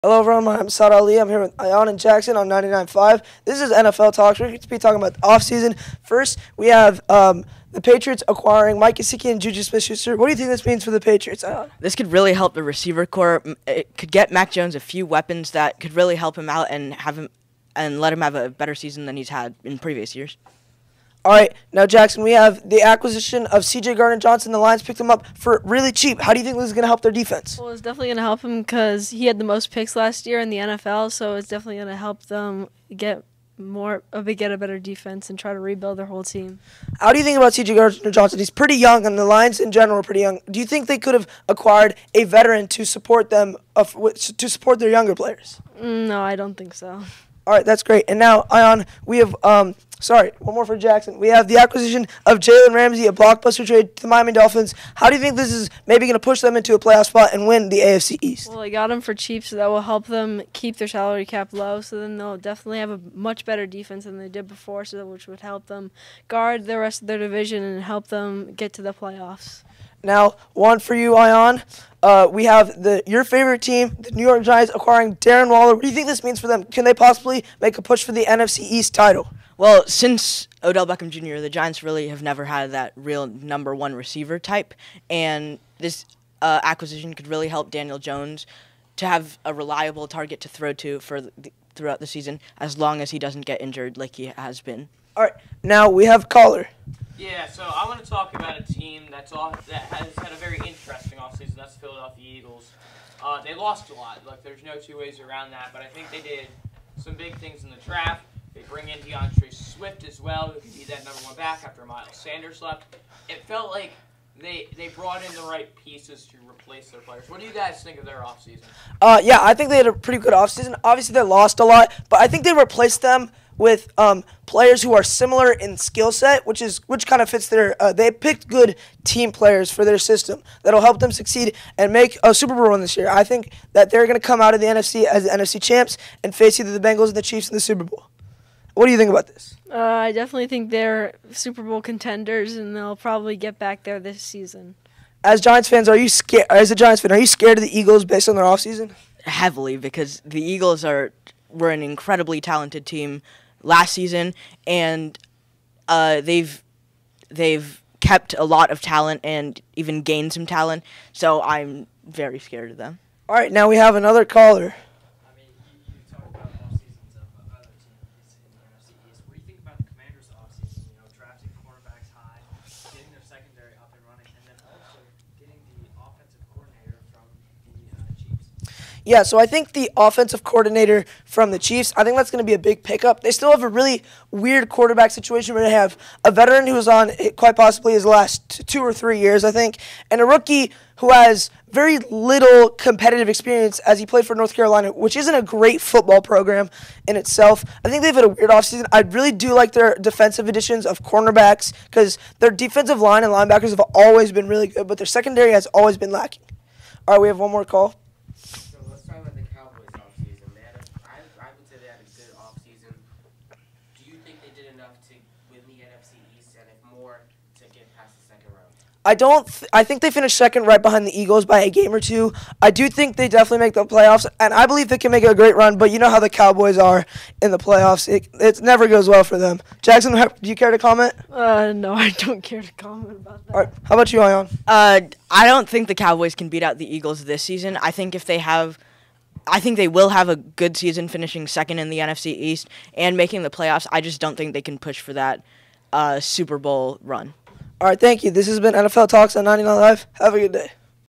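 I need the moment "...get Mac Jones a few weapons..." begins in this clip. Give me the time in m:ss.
0:14.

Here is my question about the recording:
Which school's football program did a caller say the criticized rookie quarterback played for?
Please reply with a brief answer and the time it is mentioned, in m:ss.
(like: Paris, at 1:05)
North Carolina, at 3:14.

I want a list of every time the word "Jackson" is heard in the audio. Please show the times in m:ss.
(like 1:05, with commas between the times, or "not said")
0:01, 0:21, 0:50, 3:49.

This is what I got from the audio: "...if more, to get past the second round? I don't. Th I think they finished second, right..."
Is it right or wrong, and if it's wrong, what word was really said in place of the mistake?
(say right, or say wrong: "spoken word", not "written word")
right.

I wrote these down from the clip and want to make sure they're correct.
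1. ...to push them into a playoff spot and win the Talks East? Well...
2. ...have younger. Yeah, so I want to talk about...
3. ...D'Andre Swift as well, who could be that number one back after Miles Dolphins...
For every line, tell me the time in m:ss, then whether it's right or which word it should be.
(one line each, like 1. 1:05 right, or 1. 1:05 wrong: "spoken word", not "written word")
1. 0:56 wrong: "AFC", not "Talks"
2. 1:36 wrong: "caller", not "younger"
3. 1:48 wrong: "Sanders", not "Dolphins".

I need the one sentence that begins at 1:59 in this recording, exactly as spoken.
Uh, yeah, I think they had a pretty good offseason.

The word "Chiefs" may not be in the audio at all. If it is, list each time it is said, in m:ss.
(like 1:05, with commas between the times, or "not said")
2:17, 3:01.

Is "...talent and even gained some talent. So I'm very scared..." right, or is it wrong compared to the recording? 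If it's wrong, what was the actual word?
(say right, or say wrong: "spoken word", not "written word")
right.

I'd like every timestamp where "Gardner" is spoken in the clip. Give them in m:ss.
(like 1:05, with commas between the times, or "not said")
0:23, 0:37.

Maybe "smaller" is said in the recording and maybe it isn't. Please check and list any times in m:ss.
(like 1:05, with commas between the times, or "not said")
not said.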